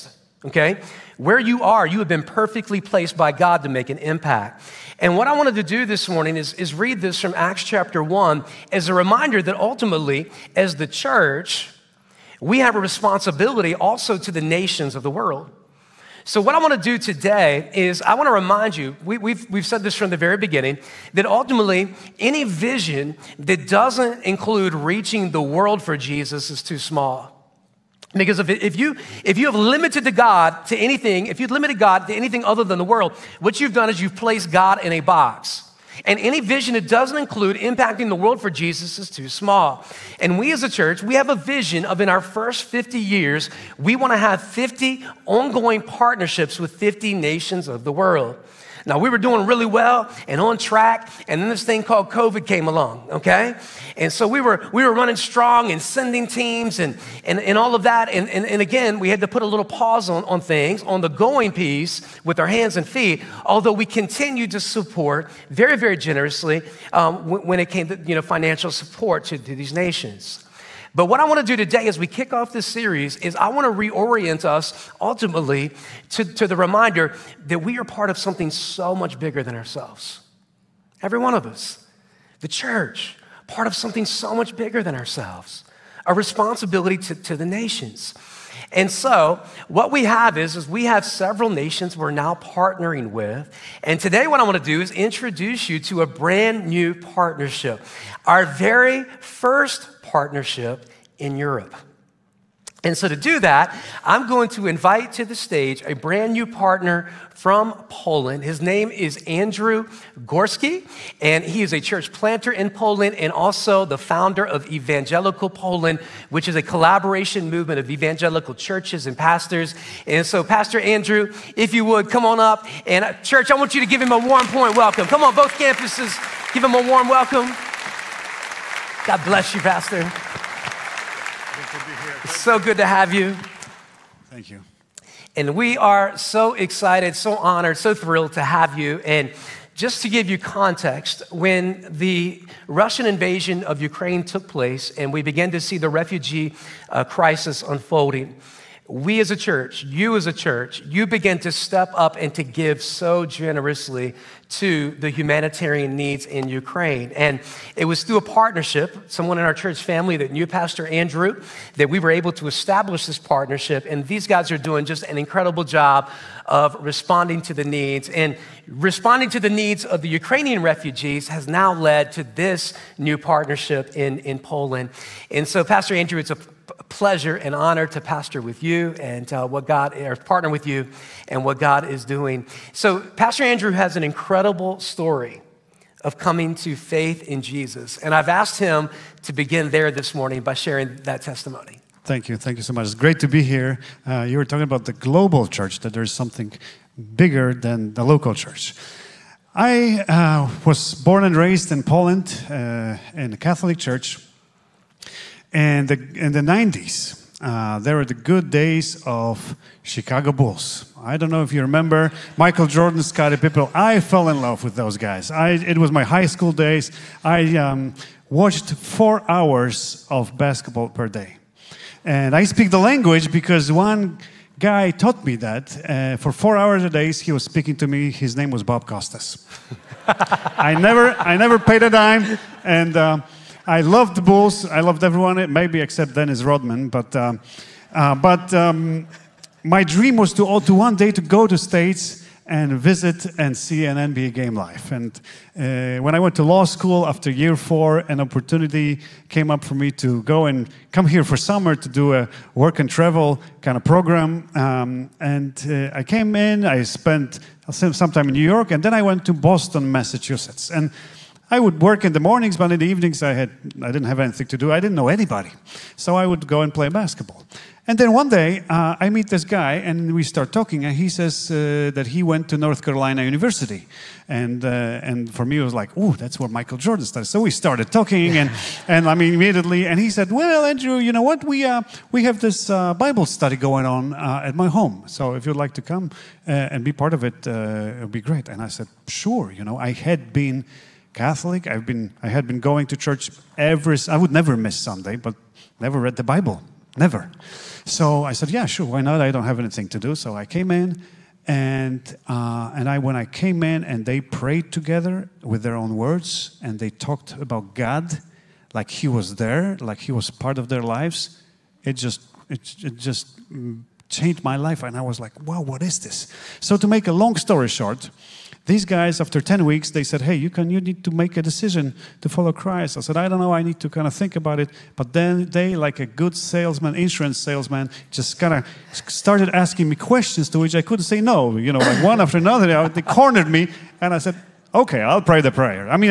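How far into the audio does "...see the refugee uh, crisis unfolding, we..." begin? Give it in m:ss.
2:25.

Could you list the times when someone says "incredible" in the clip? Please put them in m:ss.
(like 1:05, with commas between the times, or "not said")
2:45, 3:04.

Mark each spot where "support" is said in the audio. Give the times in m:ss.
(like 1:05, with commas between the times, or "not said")
1:04, 1:08.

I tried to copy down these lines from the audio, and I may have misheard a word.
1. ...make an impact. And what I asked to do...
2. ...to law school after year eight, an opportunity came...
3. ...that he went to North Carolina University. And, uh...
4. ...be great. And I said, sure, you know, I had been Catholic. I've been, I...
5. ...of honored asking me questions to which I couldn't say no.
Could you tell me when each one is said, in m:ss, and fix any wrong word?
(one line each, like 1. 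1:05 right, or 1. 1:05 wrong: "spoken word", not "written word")
1. 0:03 wrong: "wanted", not "asked"
2. 4:06 wrong: "four", not "eight"
3. 4:31 right
4. 4:48 right
5. 5:28 wrong: "started", not "honored".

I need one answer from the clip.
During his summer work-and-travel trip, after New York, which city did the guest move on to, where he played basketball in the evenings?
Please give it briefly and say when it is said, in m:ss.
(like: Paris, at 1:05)
Boston, at 4:19.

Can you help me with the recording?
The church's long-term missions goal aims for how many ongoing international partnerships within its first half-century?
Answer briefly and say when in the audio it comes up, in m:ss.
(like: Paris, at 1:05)
50, at 0:44.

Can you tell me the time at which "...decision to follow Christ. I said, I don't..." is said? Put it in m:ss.
5:21.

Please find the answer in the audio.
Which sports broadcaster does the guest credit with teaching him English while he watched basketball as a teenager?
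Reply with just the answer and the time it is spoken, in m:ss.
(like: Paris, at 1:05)
Bob Costas, at 3:48.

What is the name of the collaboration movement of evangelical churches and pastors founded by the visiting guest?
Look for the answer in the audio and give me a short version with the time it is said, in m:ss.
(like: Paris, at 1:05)
Evangelical Poland, at 1:54.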